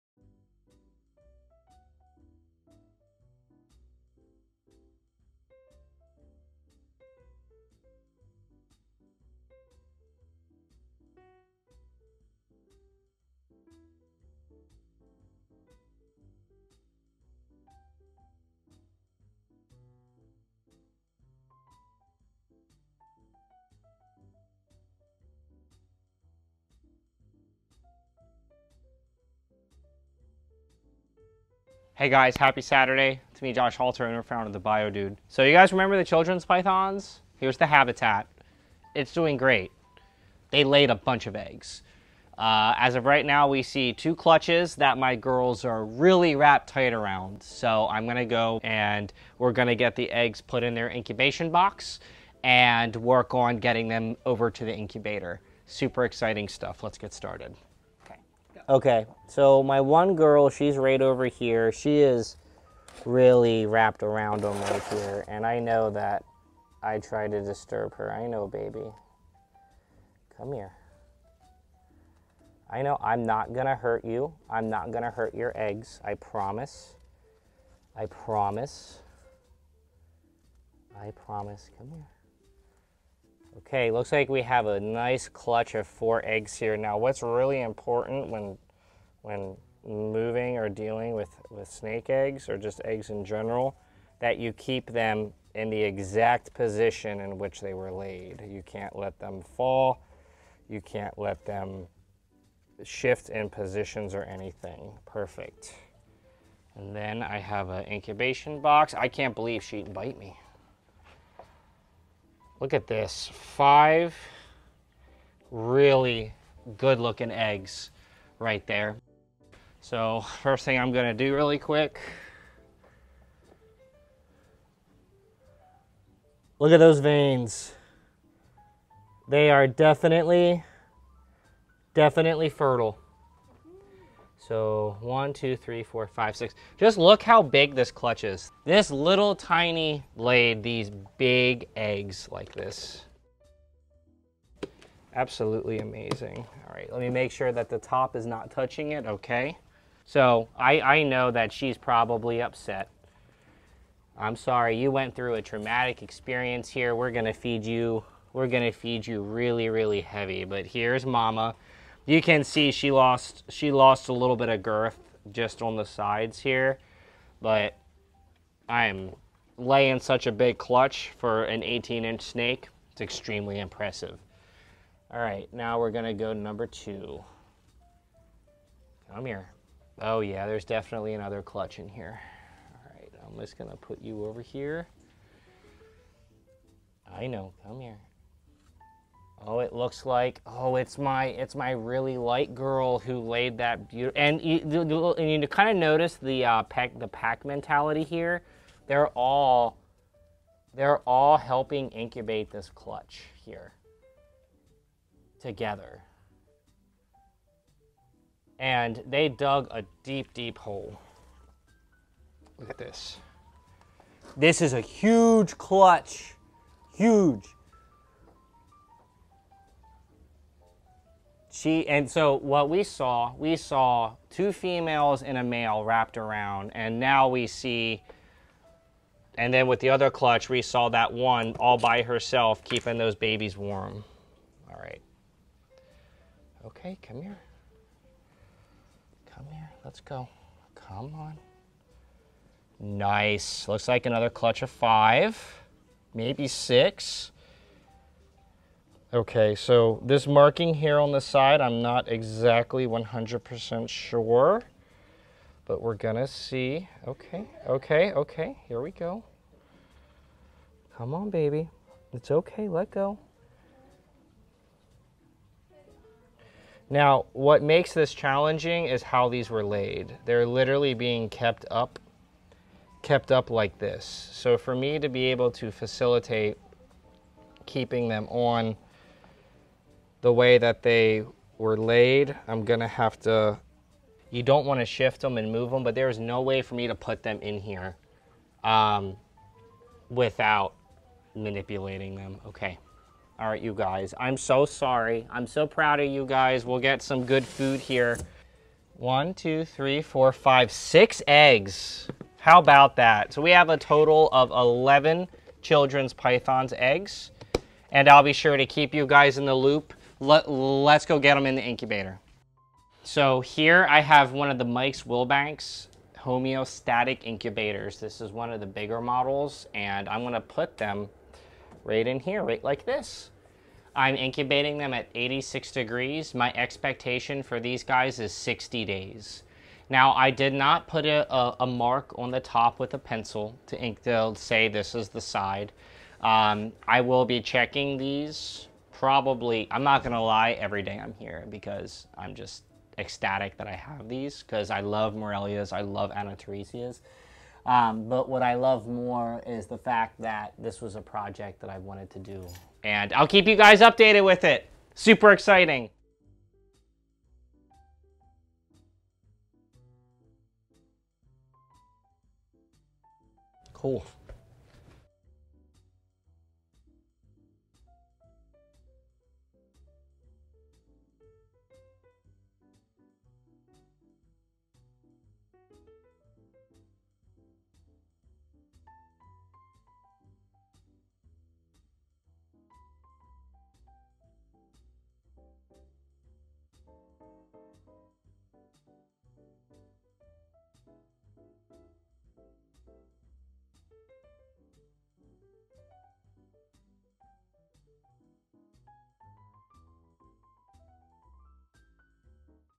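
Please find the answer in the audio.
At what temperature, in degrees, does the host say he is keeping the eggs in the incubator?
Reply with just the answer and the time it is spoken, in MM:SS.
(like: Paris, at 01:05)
86, at 05:25.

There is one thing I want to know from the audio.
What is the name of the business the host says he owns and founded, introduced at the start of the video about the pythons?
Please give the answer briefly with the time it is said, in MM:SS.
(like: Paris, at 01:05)
The Bio Dude, at 00:34.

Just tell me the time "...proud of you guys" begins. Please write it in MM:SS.
04:55.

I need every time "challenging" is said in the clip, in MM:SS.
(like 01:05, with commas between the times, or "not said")
04:28.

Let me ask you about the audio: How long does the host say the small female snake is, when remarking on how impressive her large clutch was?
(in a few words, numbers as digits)
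18 inch.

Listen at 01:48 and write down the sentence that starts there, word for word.
I can't believe she'd bite me.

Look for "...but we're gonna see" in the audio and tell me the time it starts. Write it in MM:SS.
04:15.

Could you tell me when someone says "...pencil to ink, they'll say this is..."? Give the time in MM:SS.
05:32.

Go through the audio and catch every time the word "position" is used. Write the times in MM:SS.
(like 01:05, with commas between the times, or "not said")
01:36, 01:43.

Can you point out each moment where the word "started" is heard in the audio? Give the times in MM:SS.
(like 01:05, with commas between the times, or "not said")
00:57.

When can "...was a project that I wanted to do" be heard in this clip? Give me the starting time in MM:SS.
05:50.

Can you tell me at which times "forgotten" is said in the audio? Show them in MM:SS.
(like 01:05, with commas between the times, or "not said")
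not said.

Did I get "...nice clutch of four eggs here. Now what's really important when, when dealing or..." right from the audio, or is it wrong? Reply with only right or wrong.
wrong.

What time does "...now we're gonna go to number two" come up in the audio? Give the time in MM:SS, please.
02:55.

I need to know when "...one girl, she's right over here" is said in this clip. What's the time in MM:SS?
00:59.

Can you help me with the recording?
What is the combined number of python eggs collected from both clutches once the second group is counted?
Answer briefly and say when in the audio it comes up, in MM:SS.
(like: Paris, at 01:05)
11, at 05:04.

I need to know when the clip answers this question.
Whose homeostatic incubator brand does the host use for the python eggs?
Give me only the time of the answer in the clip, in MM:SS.
05:14.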